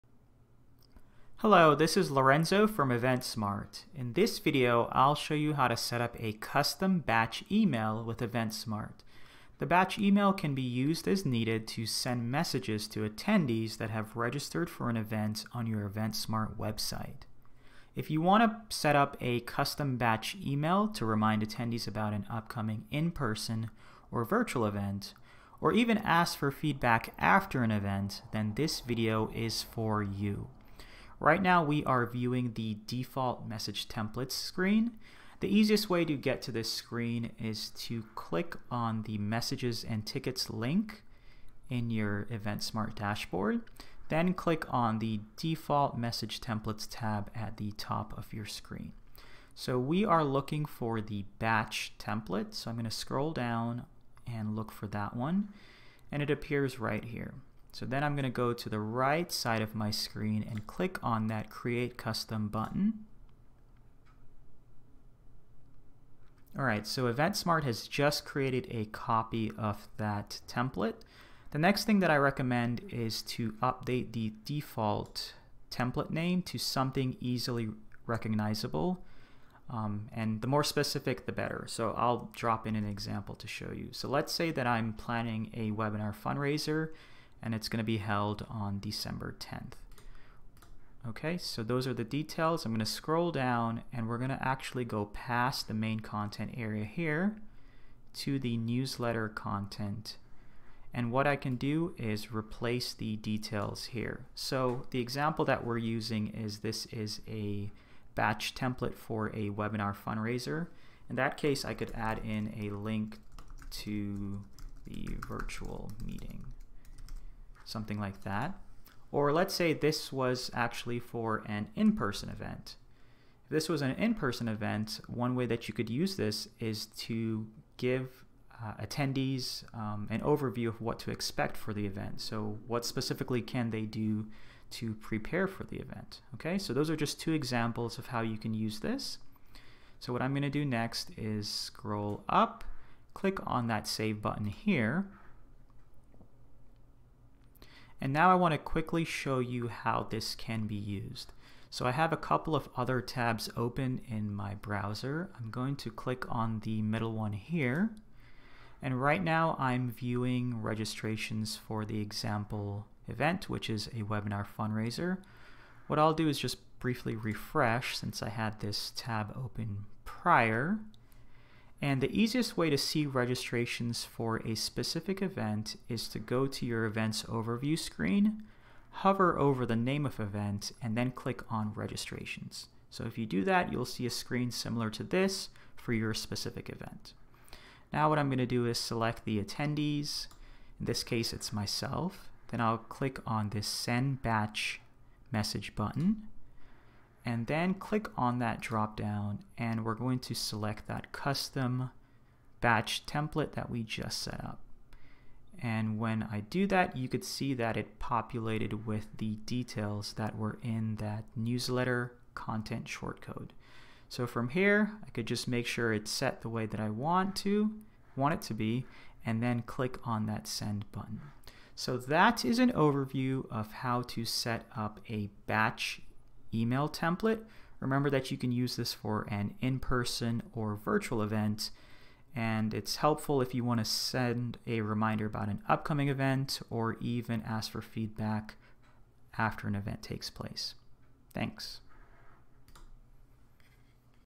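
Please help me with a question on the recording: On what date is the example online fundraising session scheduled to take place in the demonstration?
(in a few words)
December 10th.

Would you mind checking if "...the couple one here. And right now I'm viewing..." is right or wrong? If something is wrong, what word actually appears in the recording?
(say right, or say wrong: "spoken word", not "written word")
wrong: "middle", not "couple".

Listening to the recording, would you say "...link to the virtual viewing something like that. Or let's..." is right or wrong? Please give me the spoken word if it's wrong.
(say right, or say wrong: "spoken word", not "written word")
wrong: "meeting", not "viewing".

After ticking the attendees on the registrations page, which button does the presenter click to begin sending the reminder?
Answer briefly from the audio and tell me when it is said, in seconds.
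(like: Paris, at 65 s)
Send batch message, at 193 s.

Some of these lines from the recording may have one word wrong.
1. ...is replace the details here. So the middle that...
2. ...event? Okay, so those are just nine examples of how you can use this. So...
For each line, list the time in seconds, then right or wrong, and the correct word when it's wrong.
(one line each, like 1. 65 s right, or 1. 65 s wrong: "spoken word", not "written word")
1. 101 s wrong: "example", not "middle"
2. 135 s wrong: "two", not "nine".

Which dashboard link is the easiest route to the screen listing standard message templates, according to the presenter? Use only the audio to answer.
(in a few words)
Messages and tickets.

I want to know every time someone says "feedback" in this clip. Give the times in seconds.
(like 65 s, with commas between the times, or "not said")
26 s, 237 s.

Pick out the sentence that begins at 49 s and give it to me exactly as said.
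So we are looking for the batch template.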